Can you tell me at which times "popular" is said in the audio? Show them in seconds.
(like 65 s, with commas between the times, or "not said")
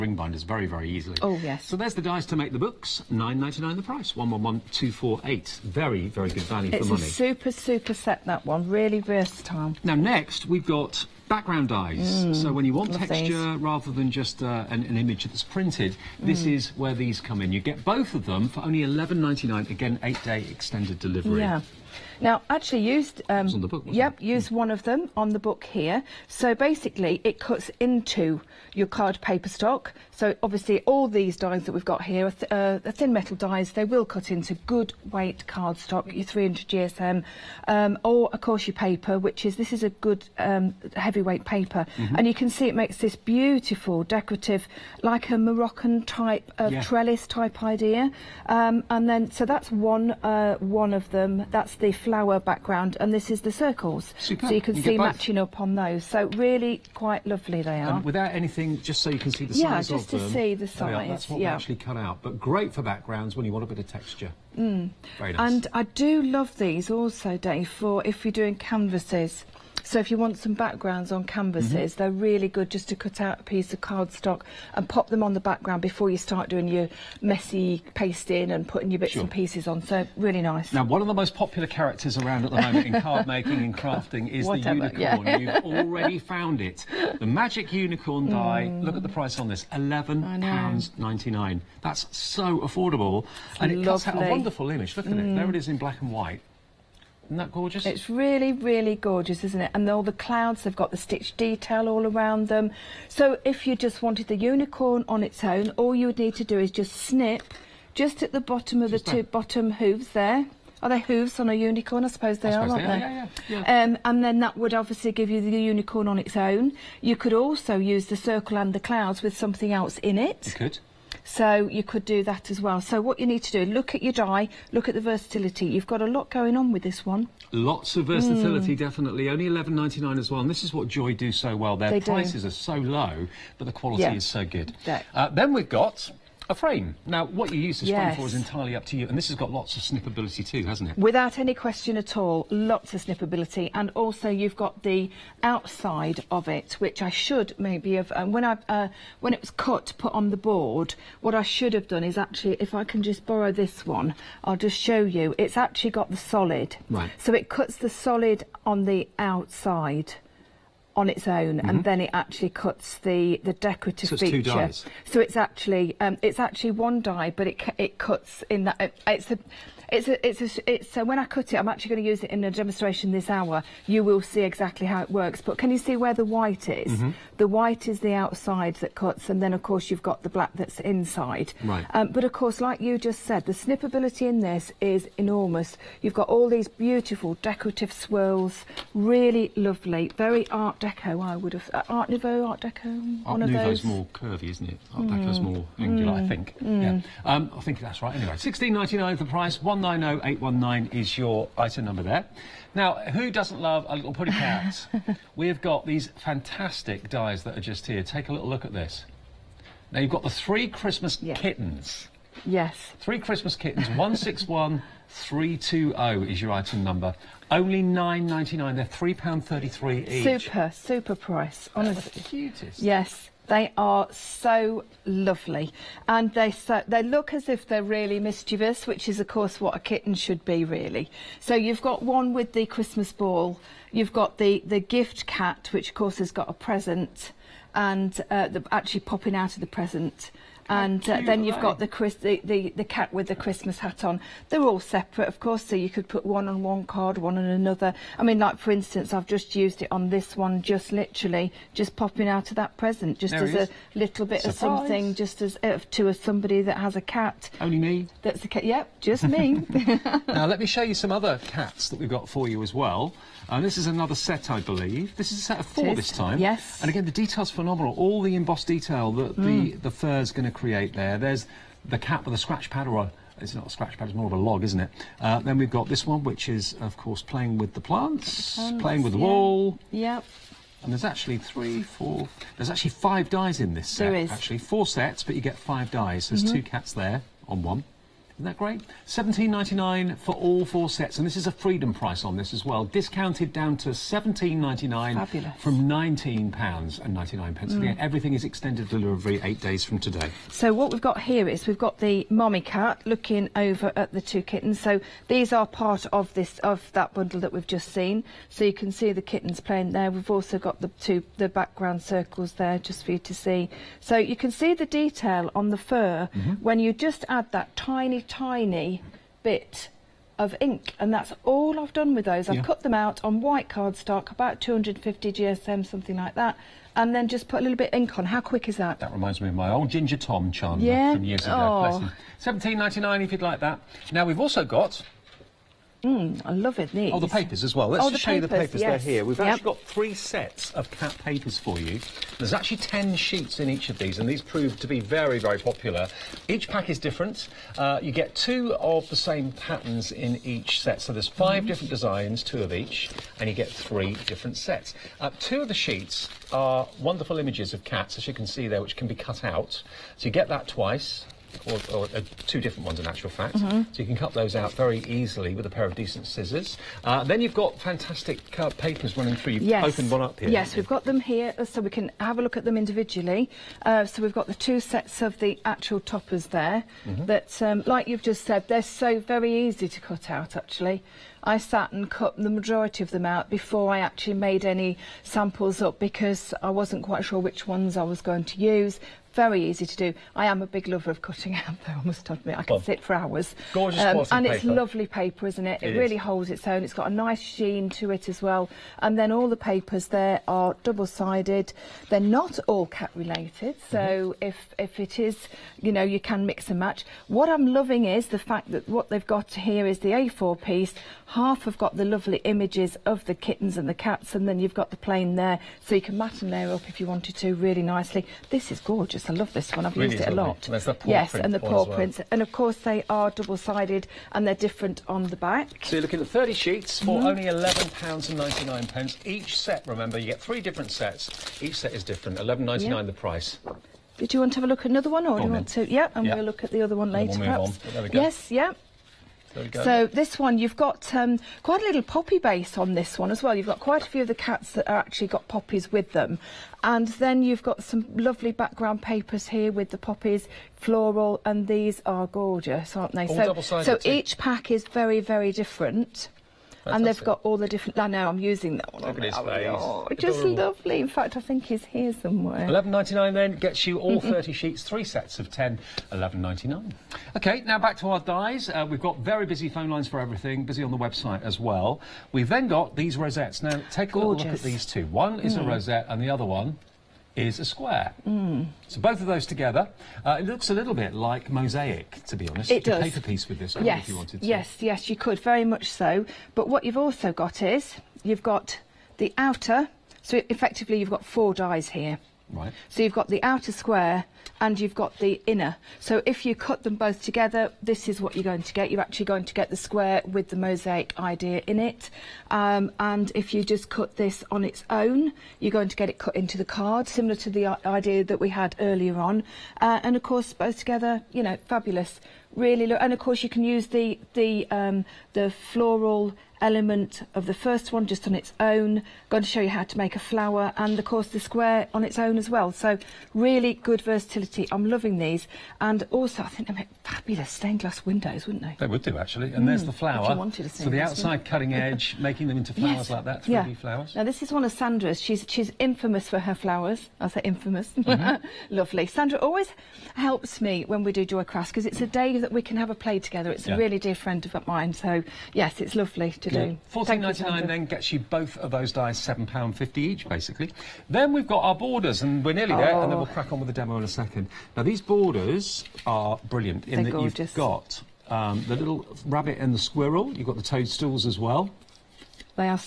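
81 s, 345 s.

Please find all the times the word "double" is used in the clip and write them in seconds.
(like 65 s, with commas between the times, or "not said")
400 s, 423 s.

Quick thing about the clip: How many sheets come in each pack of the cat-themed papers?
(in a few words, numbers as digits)
10.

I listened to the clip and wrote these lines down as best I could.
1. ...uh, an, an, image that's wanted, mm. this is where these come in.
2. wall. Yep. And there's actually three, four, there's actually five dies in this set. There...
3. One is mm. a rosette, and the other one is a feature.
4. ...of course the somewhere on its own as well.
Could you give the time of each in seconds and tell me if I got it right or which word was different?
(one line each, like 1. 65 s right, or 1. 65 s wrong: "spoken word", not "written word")
1. 14 s wrong: "printed", not "wanted"
2. 279 s right
3. 475 s wrong: "square", not "feature"
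4. 520 s wrong: "square", not "somewhere".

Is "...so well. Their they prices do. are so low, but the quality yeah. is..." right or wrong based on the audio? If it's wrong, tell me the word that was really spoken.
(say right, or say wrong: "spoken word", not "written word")
right.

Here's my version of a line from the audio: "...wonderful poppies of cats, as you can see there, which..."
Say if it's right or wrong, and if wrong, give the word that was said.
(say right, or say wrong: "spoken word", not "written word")
wrong: "images", not "poppies".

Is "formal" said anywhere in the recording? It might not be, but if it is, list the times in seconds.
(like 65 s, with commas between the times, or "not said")
not said.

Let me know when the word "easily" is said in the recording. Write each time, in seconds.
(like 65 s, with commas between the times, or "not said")
0 s, 365 s.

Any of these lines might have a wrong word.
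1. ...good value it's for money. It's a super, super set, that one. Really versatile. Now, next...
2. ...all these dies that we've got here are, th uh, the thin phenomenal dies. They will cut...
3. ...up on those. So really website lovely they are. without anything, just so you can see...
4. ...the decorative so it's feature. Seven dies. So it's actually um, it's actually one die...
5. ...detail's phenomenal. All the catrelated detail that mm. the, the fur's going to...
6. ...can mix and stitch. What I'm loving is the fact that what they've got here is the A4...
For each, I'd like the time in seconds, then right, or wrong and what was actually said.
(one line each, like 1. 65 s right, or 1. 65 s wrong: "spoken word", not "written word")
1. 6 s right
2. 30 s wrong: "metal", not "phenomenal"
3. 55 s wrong: "quite", not "website"
4. 163 s wrong: "Two", not "Seven"
5. 267 s wrong: "embossed", not "catrelated"
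6. 406 s wrong: "match", not "stitch".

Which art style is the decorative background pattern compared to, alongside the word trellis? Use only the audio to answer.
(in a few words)
Moroccan.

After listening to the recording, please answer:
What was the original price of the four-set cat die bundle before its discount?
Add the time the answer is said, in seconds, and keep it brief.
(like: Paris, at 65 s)
£19.99, at 295 s.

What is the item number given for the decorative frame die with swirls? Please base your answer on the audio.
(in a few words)
190819.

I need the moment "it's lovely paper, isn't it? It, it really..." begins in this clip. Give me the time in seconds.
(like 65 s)
394 s.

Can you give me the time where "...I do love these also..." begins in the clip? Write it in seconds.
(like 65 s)
65 s.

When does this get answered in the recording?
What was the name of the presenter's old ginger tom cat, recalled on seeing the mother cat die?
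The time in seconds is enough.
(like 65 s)
330 s.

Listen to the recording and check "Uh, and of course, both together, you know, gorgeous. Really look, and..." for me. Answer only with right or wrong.
wrong.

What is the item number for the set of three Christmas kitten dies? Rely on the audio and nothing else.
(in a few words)
161320.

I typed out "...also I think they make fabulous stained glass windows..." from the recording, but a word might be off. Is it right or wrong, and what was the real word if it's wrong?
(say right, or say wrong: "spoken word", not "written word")
right.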